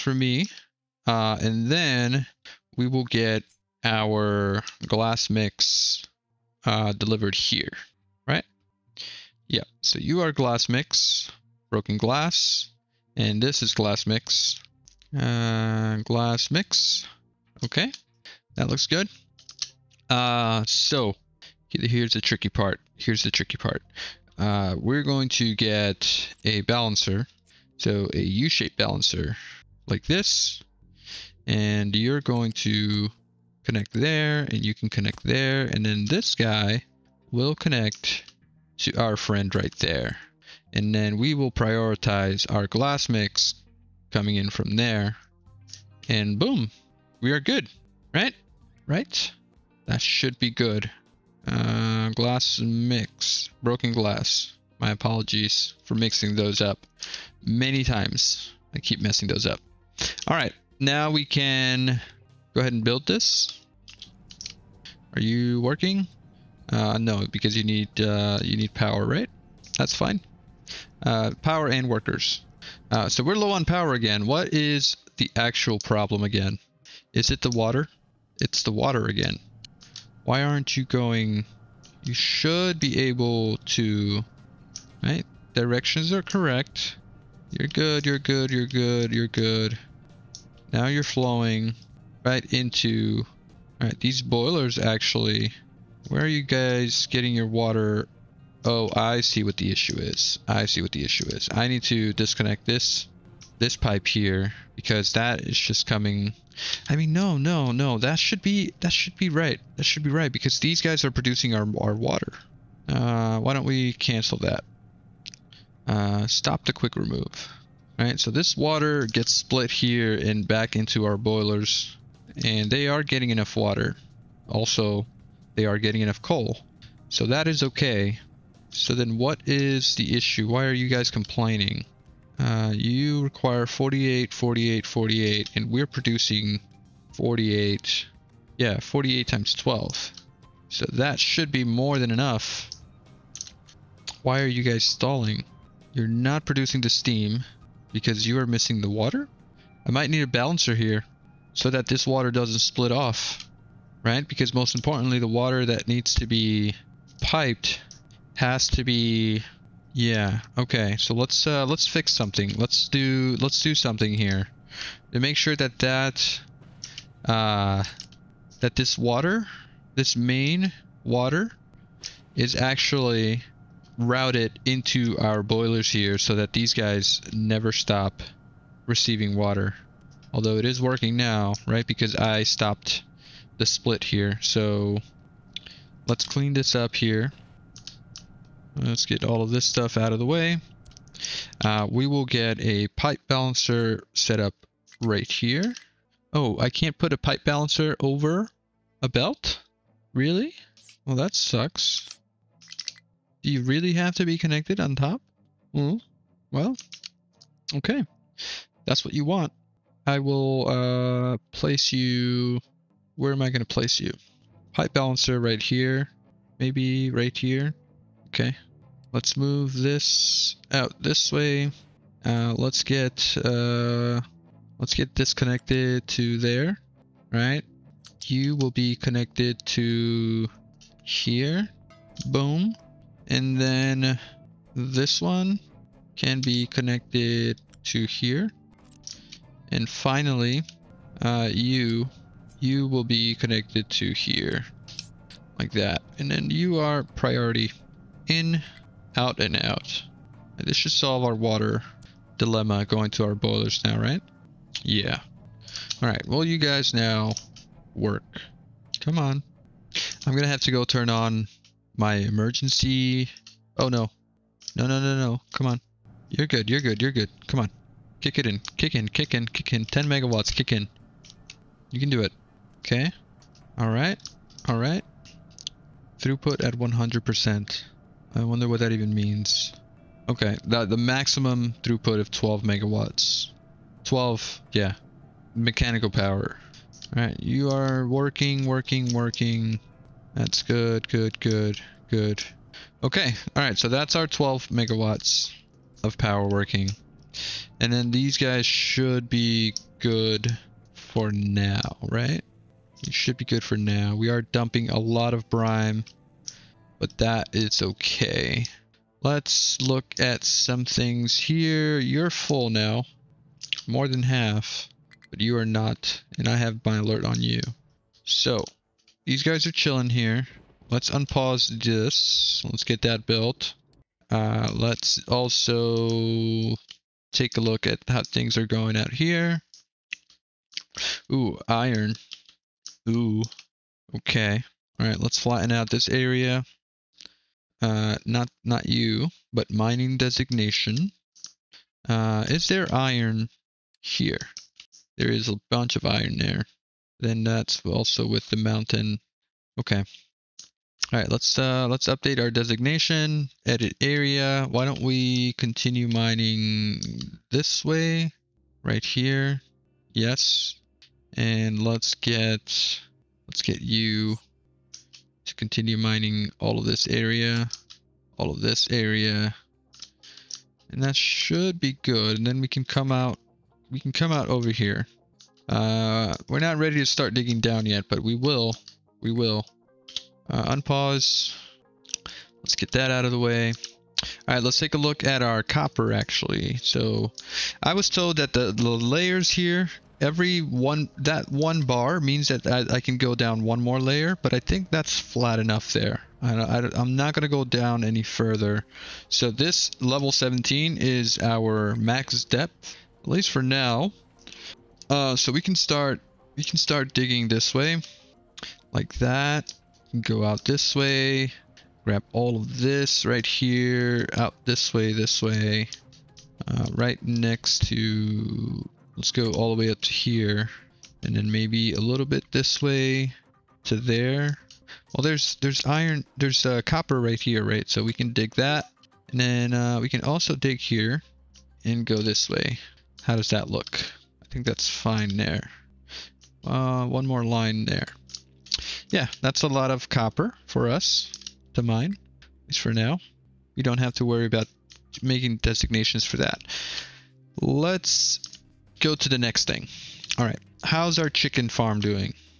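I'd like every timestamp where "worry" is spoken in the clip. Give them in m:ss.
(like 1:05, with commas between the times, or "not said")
7:24.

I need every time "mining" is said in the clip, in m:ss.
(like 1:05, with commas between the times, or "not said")
5:39, 5:56, 6:05.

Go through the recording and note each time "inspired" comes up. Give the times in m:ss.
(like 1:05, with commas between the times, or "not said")
not said.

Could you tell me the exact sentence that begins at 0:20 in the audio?
Uh, so here's the tricky part.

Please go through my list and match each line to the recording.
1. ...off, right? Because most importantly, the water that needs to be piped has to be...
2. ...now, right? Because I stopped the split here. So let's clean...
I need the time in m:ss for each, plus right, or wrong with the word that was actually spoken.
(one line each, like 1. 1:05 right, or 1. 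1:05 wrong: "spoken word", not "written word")
1. 2:32 right
2. 3:01 right.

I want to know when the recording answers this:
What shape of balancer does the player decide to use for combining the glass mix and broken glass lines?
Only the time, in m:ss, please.
0:28.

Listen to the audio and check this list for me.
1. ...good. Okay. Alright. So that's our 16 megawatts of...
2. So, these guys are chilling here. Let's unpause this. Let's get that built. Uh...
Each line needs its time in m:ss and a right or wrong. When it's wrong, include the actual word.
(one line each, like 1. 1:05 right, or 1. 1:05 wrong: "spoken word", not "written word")
1. 4:52 wrong: "12", not "16"
2. 5:18 right.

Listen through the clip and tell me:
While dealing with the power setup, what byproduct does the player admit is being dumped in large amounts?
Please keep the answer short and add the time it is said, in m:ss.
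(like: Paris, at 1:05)
brine, at 5:05.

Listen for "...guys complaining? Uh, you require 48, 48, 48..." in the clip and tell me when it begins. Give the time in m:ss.
2:10.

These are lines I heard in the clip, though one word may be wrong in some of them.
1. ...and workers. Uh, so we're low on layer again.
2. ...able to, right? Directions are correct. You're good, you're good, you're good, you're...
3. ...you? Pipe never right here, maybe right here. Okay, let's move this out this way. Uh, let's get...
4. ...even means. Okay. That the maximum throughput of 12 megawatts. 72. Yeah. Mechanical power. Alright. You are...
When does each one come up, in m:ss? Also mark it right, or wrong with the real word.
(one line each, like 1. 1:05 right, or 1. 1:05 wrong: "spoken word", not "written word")
1. 1:11 wrong: "power", not "layer"
2. 1:23 right
3. 3:33 wrong: "balancer", not "never"
4. 4:38 wrong: "12", not "72".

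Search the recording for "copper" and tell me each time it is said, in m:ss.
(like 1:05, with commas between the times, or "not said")
6:25, 7:06, 7:20.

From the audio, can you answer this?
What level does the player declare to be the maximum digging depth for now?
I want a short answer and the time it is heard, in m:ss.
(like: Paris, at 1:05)
level 17, at 6:40.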